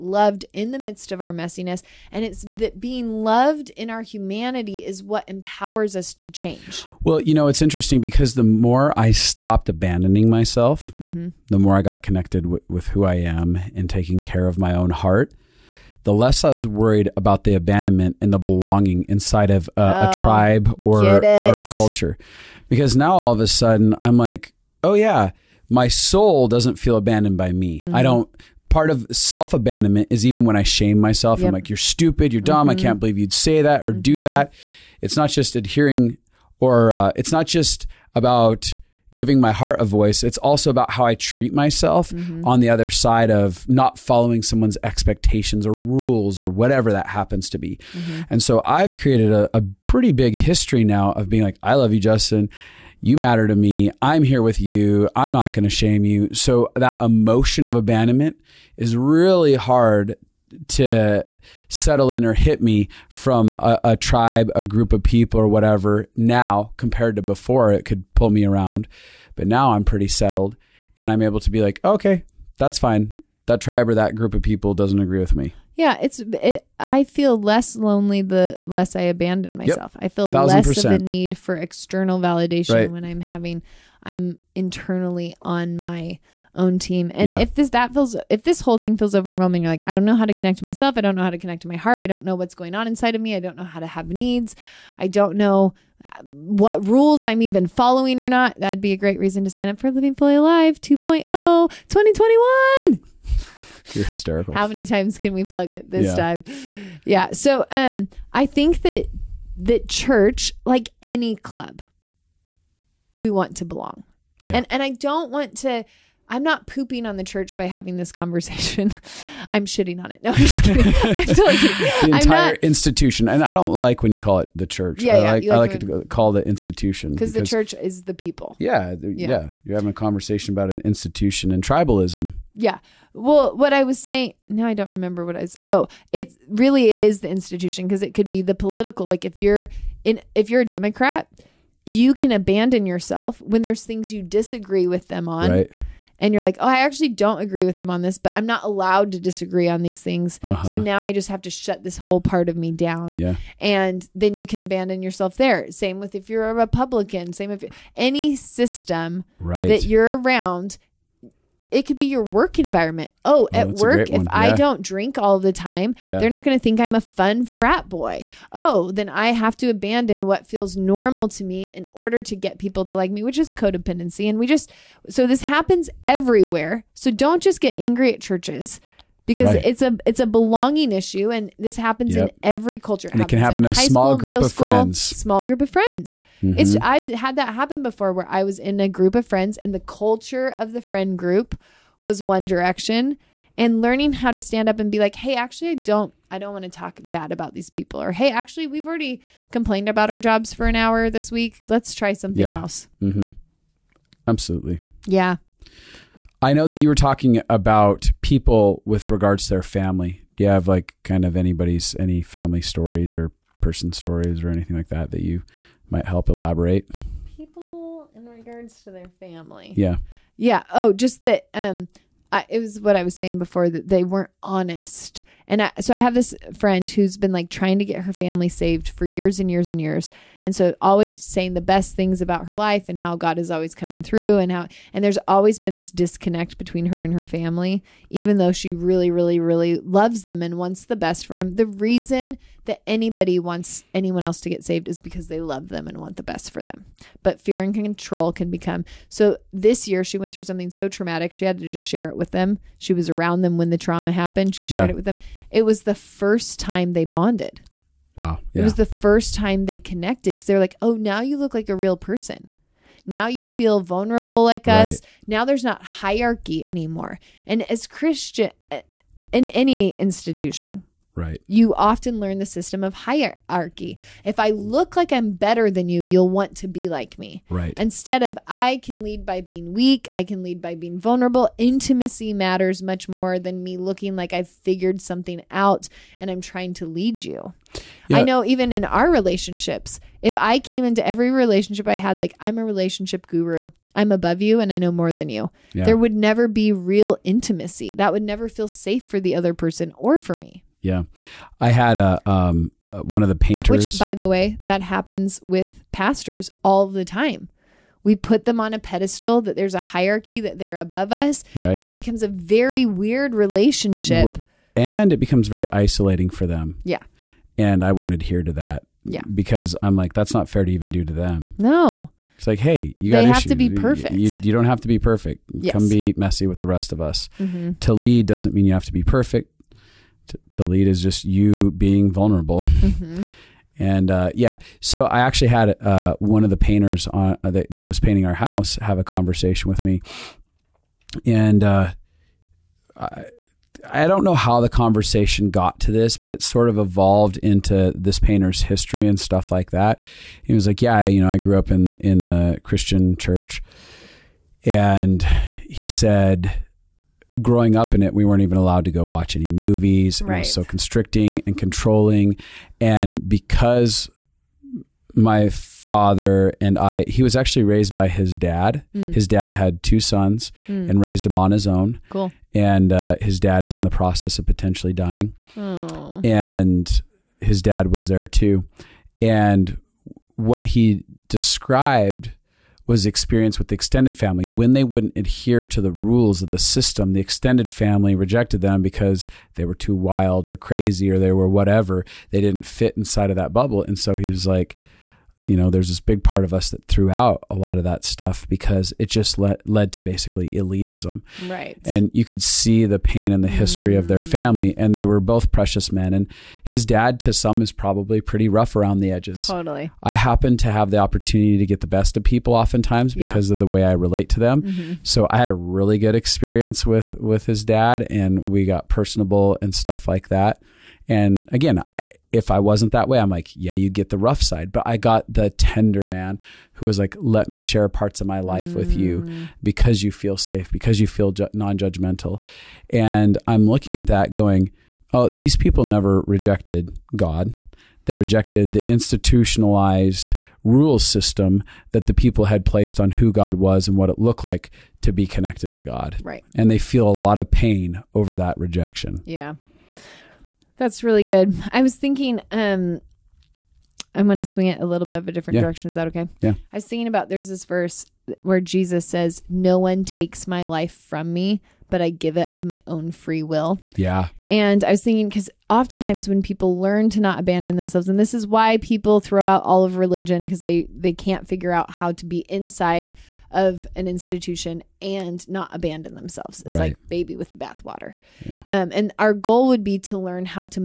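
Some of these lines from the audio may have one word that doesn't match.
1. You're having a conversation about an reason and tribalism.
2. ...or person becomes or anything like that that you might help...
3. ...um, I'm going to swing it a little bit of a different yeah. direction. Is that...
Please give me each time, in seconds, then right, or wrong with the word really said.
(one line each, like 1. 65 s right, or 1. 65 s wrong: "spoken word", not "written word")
1. 129 s wrong: "institution", not "reason"
2. 213 s wrong: "stories", not "becomes"
3. 452 s right.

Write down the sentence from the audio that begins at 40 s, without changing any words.
It's also about how I treat myself mm-hmm.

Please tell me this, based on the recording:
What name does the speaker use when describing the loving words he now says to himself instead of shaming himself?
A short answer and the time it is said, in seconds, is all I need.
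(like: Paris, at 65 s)
Justin, at 51 s.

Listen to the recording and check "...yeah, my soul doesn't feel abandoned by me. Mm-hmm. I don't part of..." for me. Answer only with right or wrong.
right.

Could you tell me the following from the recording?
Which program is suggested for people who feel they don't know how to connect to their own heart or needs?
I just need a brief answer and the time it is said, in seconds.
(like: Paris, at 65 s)
Living Fully Alive 2.0, at 99 s.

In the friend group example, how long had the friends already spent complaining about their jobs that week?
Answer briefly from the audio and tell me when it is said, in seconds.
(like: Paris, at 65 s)
an hour, at 200 s.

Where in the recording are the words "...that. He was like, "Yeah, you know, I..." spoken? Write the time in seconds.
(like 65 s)
349 s.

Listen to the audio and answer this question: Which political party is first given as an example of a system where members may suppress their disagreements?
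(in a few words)
Democrat.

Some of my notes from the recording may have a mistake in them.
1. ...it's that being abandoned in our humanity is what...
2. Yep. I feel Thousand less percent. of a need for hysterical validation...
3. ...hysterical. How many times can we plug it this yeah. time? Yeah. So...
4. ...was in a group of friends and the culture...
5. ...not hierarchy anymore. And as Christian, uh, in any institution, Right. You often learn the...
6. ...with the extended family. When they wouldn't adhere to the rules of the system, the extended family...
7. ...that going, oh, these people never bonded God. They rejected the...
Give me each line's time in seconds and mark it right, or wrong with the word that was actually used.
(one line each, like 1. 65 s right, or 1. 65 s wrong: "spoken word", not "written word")
1. 2 s wrong: "loved", not "abandoned"
2. 79 s wrong: "external", not "hysterical"
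3. 104 s right
4. 188 s right
5. 265 s right
6. 383 s right
7. 434 s wrong: "rejected", not "bonded".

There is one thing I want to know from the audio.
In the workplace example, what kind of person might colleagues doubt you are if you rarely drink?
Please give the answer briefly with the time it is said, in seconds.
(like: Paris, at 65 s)
fun frat boy, at 167 s.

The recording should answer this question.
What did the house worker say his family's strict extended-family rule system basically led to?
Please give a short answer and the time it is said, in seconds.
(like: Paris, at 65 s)
elitism, at 400 s.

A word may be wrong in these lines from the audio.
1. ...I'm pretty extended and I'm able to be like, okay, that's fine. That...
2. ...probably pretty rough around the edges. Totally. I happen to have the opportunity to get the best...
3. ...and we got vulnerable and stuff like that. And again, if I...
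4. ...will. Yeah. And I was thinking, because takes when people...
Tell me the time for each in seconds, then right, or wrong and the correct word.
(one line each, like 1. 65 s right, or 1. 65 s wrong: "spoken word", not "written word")
1. 69 s wrong: "settled", not "extended"
2. 407 s right
3. 418 s wrong: "personable", not "vulnerable"
4. 463 s wrong: "oftentimes", not "takes".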